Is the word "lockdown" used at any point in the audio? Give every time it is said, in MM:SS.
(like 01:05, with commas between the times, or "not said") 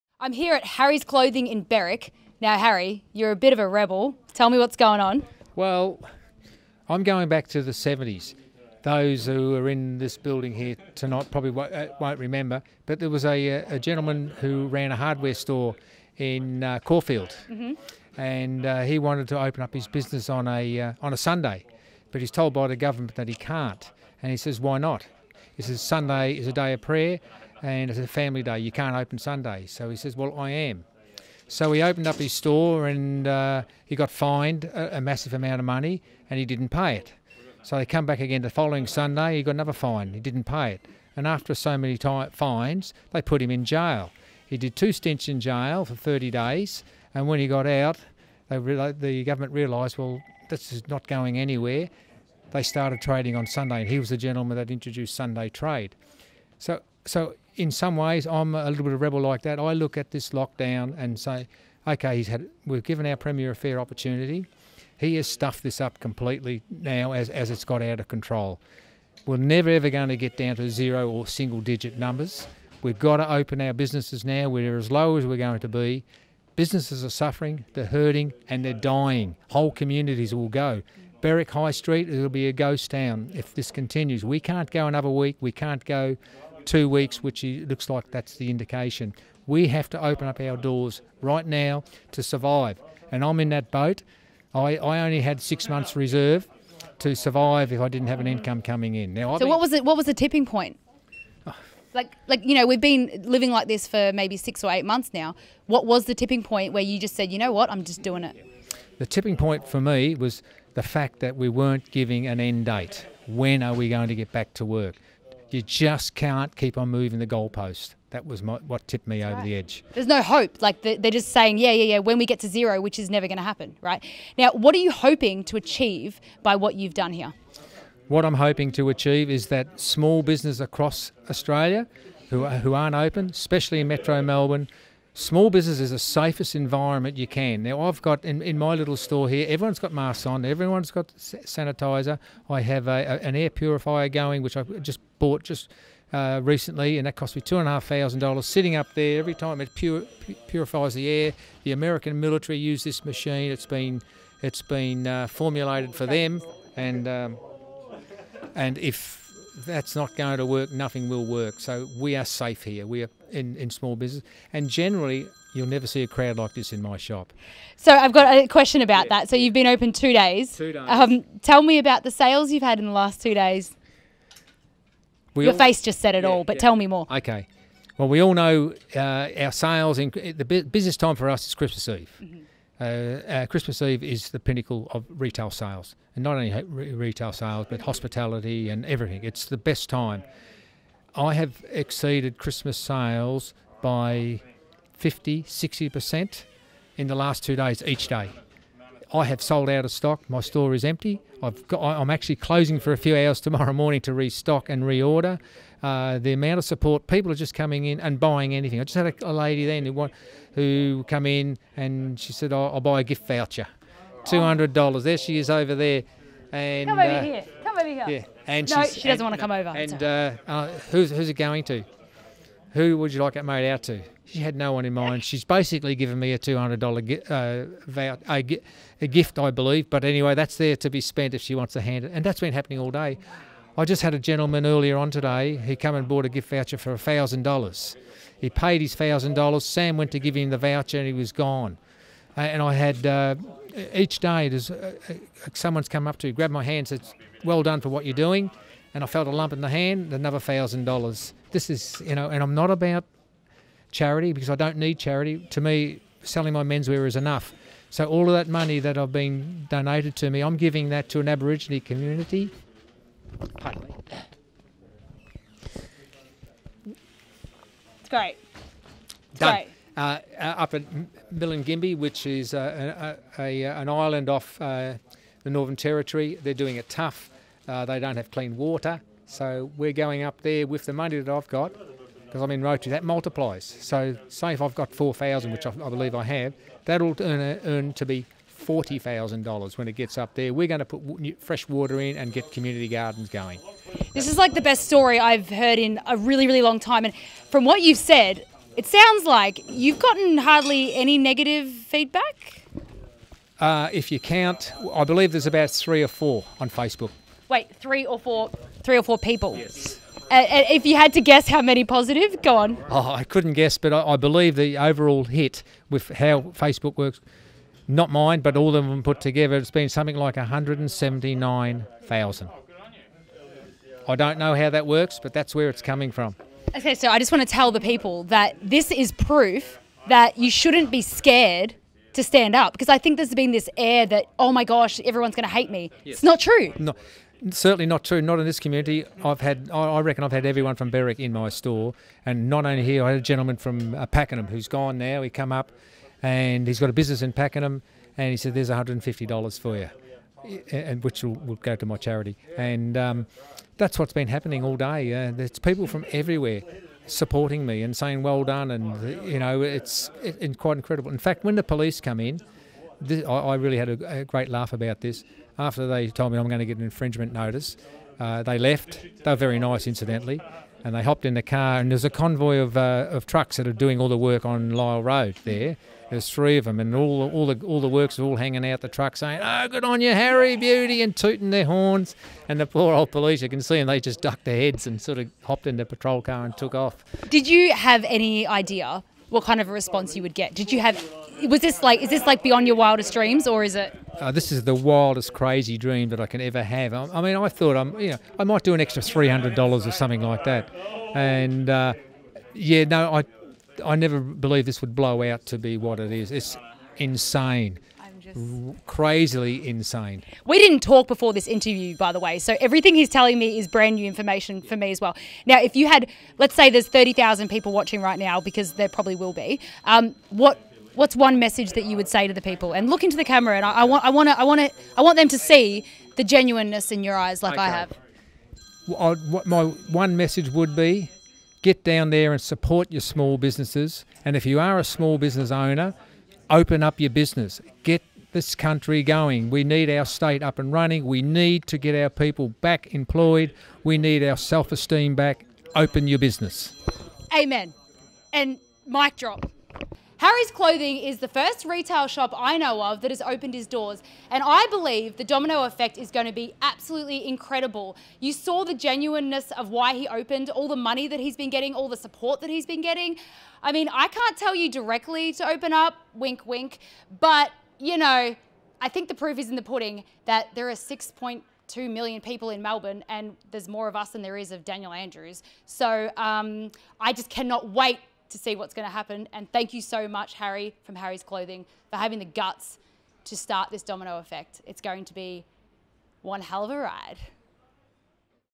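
01:00.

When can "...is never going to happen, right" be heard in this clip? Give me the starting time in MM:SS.
02:02.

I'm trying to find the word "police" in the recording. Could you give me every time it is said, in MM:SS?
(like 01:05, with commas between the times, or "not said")
06:01, 06:23.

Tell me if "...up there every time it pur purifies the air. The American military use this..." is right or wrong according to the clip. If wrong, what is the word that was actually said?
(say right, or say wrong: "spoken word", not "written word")
right.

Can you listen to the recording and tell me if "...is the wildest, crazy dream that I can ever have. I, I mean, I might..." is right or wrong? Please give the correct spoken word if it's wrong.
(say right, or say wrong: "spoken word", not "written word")
wrong: "thought", not "might".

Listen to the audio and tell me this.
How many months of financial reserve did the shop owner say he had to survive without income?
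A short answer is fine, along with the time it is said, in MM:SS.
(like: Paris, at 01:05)
6 months, at 01:35.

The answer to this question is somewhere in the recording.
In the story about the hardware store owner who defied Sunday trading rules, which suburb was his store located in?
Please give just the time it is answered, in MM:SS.
00:16.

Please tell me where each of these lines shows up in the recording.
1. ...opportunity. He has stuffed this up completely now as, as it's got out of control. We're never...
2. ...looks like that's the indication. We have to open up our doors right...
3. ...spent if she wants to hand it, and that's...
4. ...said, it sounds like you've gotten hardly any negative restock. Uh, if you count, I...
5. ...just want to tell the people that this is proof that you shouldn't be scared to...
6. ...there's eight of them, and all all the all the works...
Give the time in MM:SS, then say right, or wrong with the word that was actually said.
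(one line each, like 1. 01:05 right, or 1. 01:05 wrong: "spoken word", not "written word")
1. 01:03 right
2. 01:27 right
3. 03:51 right
4. 04:57 wrong: "feedback", not "restock"
5. 05:27 right
6. 06:16 wrong: "three", not "eight".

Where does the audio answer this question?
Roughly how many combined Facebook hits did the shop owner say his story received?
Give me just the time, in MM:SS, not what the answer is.
05:20.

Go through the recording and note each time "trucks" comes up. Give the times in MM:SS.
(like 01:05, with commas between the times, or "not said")
06:13, 06:18.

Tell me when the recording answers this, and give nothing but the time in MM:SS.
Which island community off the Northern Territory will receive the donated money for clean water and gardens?
04:31.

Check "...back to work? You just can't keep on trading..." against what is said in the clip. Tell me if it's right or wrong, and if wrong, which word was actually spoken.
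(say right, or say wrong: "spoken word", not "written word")
wrong: "moving", not "trading".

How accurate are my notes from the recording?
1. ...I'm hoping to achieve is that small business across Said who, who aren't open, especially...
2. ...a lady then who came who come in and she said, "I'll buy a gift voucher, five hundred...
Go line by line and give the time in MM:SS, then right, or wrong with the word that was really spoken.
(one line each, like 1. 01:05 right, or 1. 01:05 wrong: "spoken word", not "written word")
1. 02:08 wrong: "Australia", not "Said"
2. 03:29 wrong: "two", not "five".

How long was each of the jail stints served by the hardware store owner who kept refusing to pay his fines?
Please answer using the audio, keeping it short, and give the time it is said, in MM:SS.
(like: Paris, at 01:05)
30 days, at 00:45.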